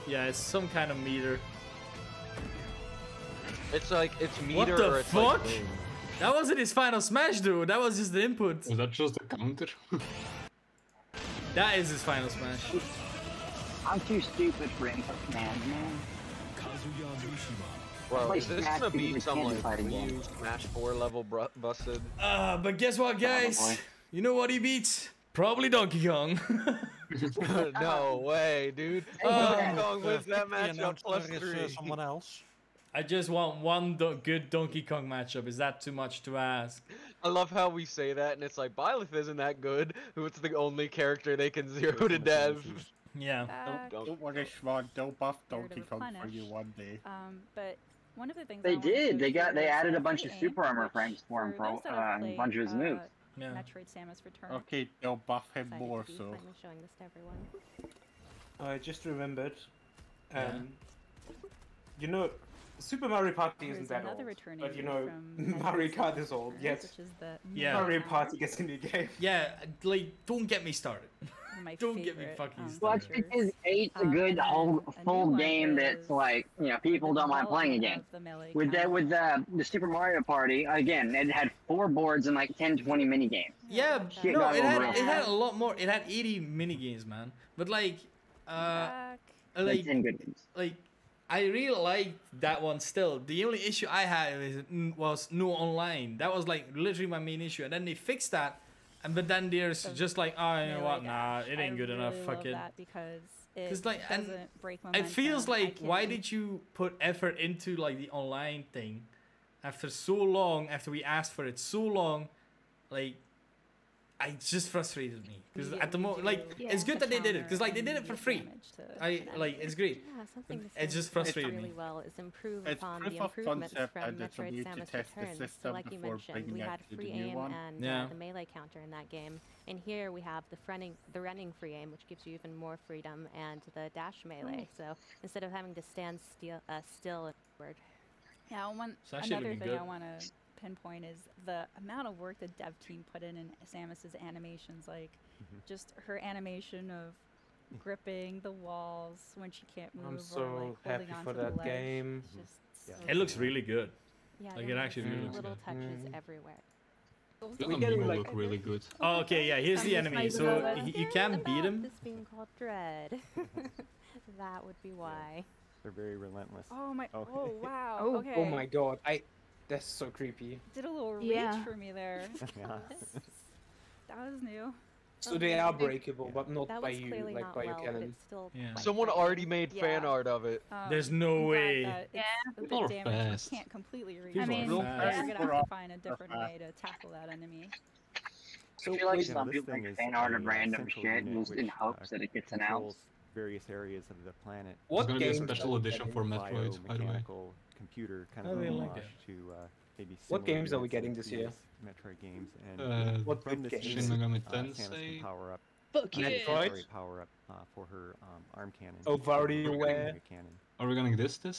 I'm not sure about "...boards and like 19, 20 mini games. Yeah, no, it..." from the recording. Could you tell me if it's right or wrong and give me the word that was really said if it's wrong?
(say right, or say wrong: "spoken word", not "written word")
wrong: "10", not "19".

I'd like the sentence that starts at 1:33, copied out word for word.
The only issue I had was no online.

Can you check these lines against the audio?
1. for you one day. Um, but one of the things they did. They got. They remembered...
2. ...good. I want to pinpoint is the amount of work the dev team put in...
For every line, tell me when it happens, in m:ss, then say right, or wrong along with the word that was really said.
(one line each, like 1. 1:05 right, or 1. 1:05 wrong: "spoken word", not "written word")
1. 0:46 wrong: "added", not "remembered"
2. 2:19 right.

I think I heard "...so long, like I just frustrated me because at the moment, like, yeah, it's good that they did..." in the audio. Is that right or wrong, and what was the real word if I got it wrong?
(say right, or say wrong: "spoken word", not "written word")
right.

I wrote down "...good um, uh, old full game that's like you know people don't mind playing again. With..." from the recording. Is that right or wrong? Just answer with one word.
right.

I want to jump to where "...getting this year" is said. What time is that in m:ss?
3:20.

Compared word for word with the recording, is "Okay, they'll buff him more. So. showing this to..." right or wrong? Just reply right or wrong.
right.